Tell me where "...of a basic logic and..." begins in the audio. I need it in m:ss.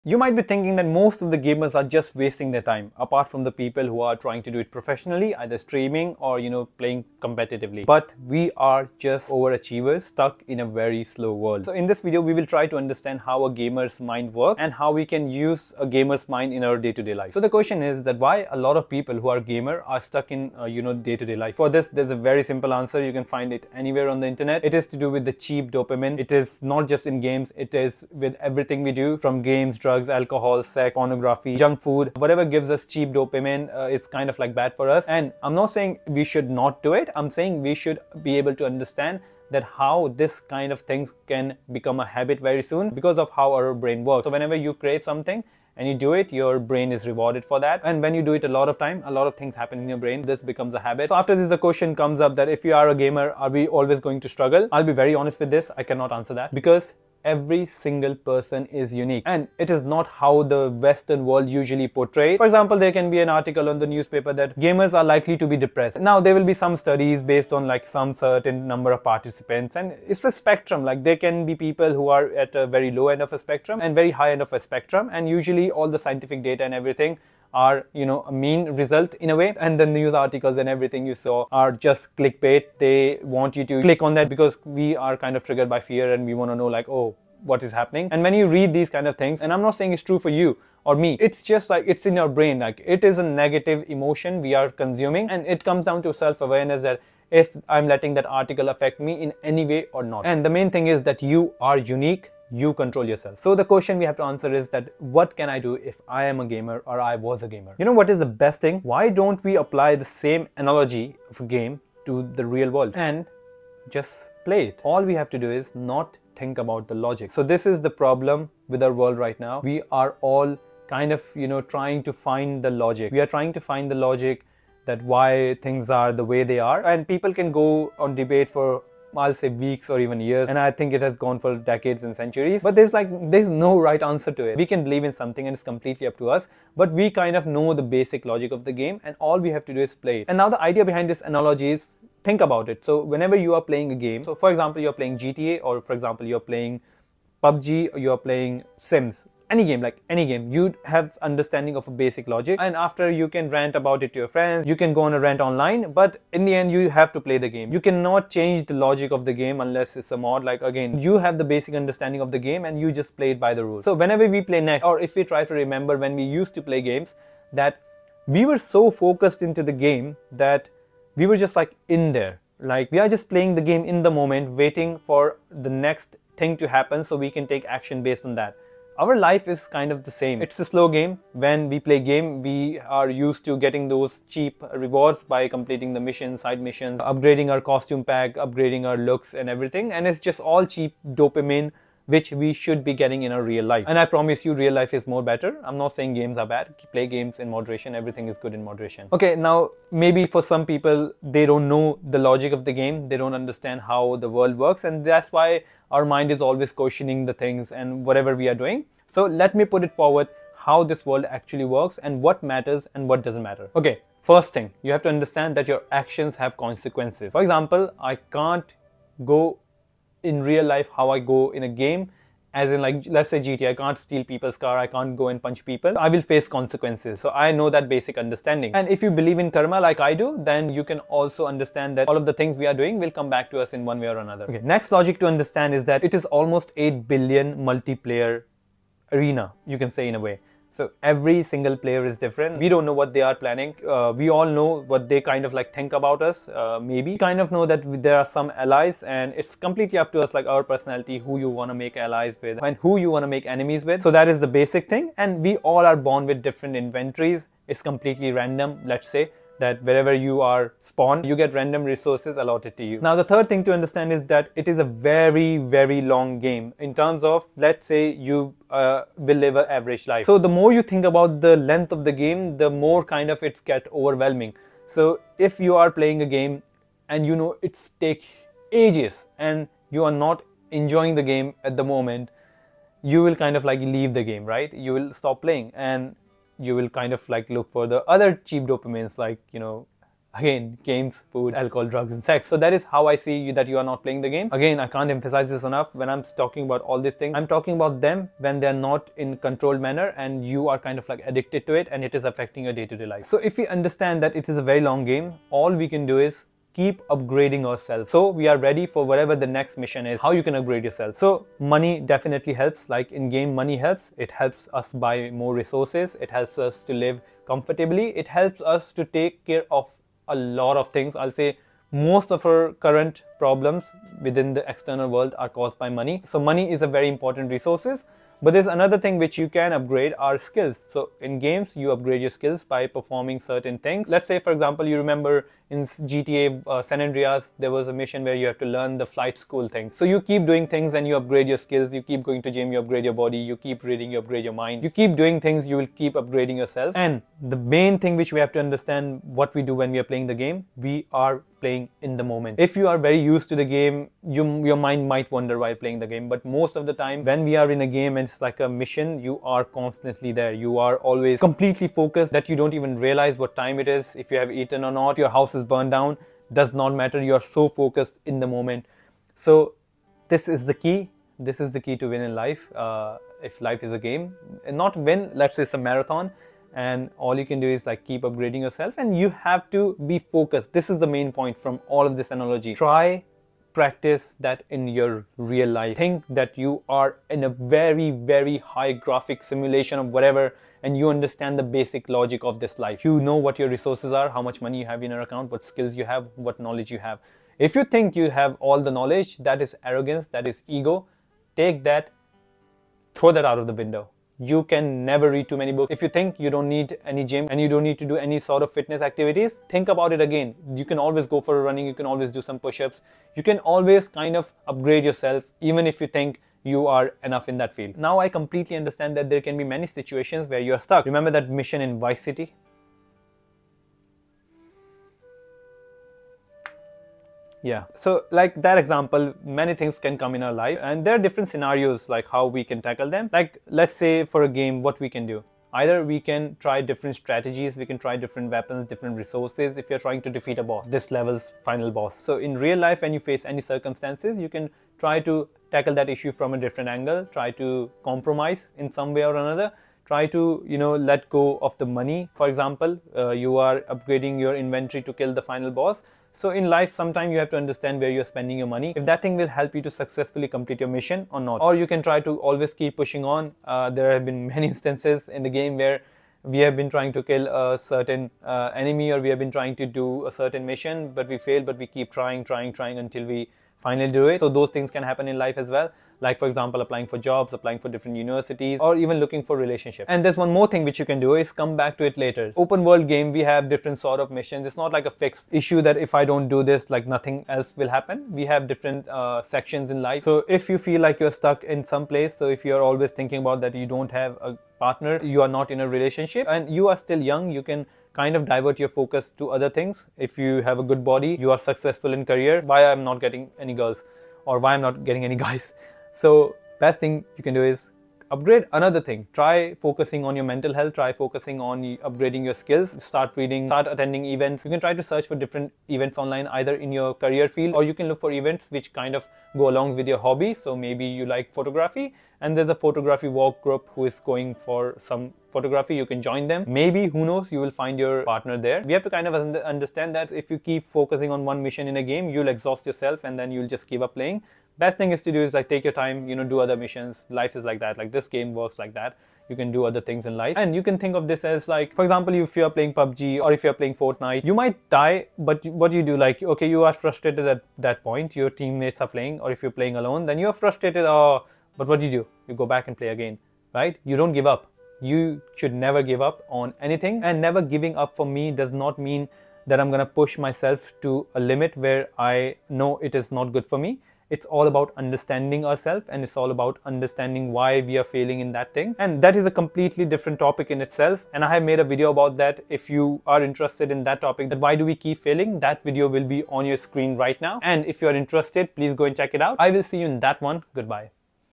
2:31.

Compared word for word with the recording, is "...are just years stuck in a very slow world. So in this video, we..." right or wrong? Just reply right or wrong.
wrong.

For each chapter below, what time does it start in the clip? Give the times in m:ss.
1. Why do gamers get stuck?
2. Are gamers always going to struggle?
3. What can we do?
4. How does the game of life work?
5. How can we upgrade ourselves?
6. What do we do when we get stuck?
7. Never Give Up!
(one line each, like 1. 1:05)
1. 0:17
2. 0:51
3. 1:43
4. 3:29
5. 5:10
6. 6:57
7. 9:00.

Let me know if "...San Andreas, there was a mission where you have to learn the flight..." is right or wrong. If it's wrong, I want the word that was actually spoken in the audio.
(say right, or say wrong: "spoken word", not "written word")
right.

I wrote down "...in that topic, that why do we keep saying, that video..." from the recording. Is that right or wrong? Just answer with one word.
wrong.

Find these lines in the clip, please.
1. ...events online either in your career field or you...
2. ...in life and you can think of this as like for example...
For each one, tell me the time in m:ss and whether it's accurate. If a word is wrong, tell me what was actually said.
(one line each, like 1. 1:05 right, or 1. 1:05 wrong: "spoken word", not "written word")
1. 8:35 right
2. 9:00 right.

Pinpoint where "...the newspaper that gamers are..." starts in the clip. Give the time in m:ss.
1:03.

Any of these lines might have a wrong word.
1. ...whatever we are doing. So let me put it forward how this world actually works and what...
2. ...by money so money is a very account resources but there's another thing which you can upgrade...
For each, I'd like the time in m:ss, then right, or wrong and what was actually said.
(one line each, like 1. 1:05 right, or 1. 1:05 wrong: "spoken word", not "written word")
1. 3:28 right
2. 5:25 wrong: "important", not "account".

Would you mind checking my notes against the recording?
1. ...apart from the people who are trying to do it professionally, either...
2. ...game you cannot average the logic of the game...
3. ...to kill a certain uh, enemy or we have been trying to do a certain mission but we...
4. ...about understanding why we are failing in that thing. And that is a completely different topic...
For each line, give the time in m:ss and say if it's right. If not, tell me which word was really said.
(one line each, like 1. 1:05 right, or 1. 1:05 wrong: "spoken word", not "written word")
1. 0:02 right
2. 2:37 wrong: "change", not "average"
3. 7:47 right
4. 9:26 right.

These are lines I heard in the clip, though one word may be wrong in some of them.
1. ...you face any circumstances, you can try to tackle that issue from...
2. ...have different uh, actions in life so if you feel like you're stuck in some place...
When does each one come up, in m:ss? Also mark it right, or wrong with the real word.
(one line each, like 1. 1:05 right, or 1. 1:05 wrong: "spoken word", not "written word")
1. 7:23 right
2. 8:08 wrong: "sections", not "actions".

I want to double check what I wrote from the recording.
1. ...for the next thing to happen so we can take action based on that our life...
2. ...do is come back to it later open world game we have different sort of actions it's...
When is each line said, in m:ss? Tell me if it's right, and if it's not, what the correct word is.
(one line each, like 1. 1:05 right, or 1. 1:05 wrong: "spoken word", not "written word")
1. 2:55 right
2. 8:01 wrong: "missions", not "actions".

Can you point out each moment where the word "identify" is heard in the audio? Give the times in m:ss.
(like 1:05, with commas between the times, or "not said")
not said.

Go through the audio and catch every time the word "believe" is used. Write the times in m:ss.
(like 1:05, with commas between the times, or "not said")
2:14, 3:49.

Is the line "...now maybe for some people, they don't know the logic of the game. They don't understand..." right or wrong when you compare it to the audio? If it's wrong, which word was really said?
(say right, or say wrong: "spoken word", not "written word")
right.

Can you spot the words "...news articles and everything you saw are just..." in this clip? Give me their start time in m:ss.
1:19.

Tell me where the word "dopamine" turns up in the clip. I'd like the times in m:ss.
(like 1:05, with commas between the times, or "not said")
0:25, 0:33, 3:11, 4:48.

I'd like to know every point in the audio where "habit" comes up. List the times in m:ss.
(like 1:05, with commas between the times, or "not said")
0:42, 0:50.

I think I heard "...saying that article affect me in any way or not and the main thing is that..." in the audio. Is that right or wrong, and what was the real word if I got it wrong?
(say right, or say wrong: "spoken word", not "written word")
wrong: "letting", not "saying".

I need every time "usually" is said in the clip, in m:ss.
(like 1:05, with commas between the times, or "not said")
1:01, 1:15.